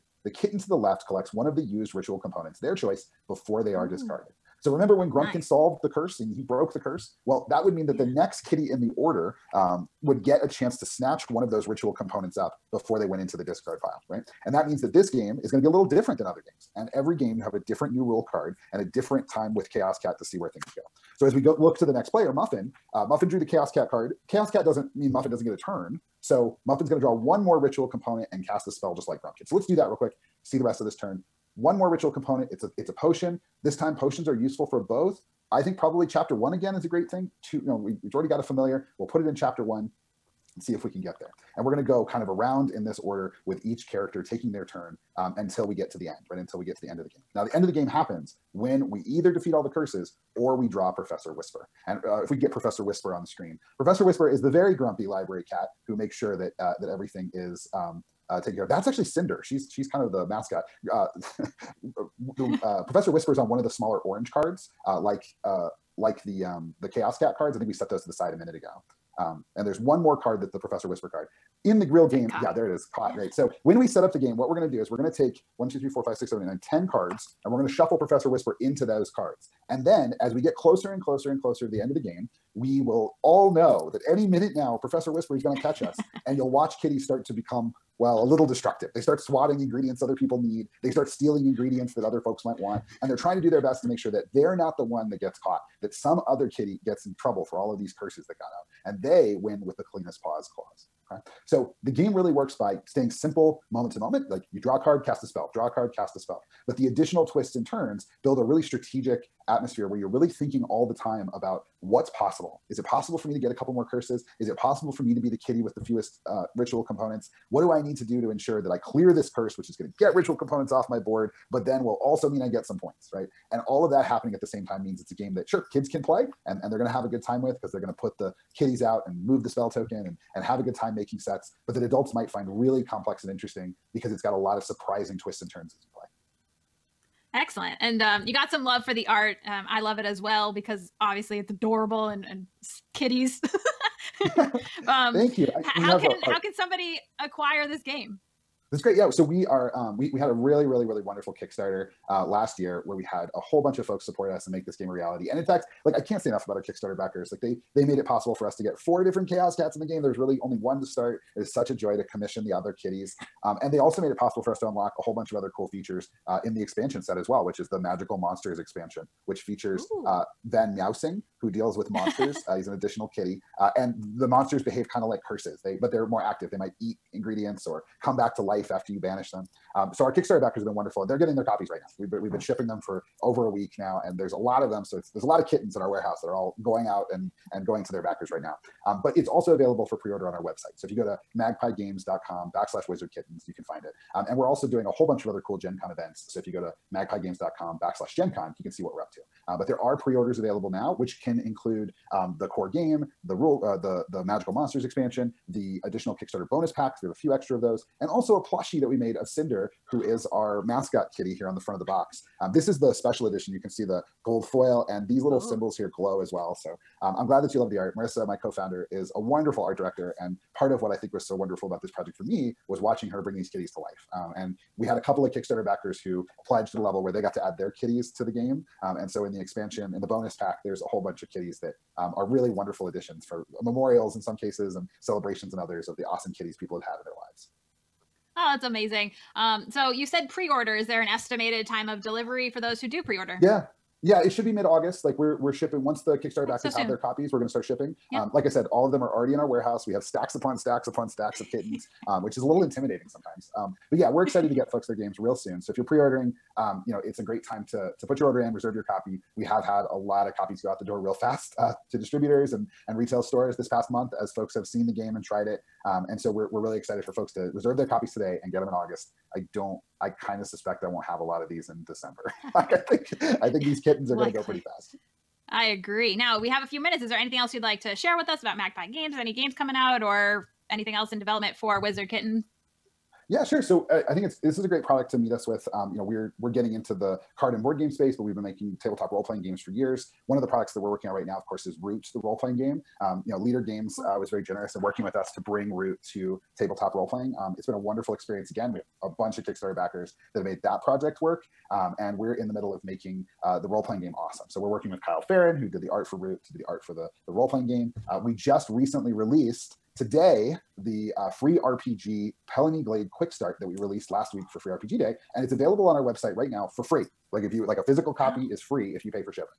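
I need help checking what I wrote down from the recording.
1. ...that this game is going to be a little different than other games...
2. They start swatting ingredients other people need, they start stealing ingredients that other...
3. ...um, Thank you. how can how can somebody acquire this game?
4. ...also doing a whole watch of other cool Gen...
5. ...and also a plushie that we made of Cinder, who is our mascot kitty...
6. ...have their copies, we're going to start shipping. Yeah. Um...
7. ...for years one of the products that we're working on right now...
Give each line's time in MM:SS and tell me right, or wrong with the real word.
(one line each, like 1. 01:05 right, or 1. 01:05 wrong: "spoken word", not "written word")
1. 00:14 right
2. 01:28 right
3. 02:24 right
4. 03:14 wrong: "bunch", not "watch"
5. 03:28 right
6. 04:06 right
7. 04:49 right.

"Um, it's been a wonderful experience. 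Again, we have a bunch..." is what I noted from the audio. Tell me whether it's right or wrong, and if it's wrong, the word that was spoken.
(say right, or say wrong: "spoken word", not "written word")
right.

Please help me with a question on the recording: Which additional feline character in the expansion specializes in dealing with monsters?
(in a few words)
Van Meowsing.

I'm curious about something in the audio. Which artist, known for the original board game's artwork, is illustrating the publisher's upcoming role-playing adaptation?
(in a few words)
Kyle Ferrin.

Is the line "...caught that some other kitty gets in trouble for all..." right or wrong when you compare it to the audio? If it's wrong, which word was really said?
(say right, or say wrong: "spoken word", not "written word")
right.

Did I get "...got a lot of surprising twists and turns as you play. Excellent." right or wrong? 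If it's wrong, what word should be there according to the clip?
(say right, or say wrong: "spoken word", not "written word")
right.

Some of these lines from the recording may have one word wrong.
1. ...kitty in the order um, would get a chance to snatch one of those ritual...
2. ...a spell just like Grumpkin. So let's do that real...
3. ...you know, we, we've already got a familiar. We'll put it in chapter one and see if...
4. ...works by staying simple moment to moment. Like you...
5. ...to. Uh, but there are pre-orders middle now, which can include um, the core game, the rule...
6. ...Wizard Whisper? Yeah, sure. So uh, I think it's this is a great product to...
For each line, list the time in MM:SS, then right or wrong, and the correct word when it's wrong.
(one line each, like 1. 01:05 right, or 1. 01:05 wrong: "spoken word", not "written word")
1. 00:08 right
2. 00:28 right
3. 00:37 right
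4. 01:42 right
5. 03:19 wrong: "available", not "middle"
6. 04:41 wrong: "Kitten", not "Whisper".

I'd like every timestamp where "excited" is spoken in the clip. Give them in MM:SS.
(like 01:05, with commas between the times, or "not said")
04:14, 04:26.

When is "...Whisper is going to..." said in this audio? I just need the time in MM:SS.
01:25.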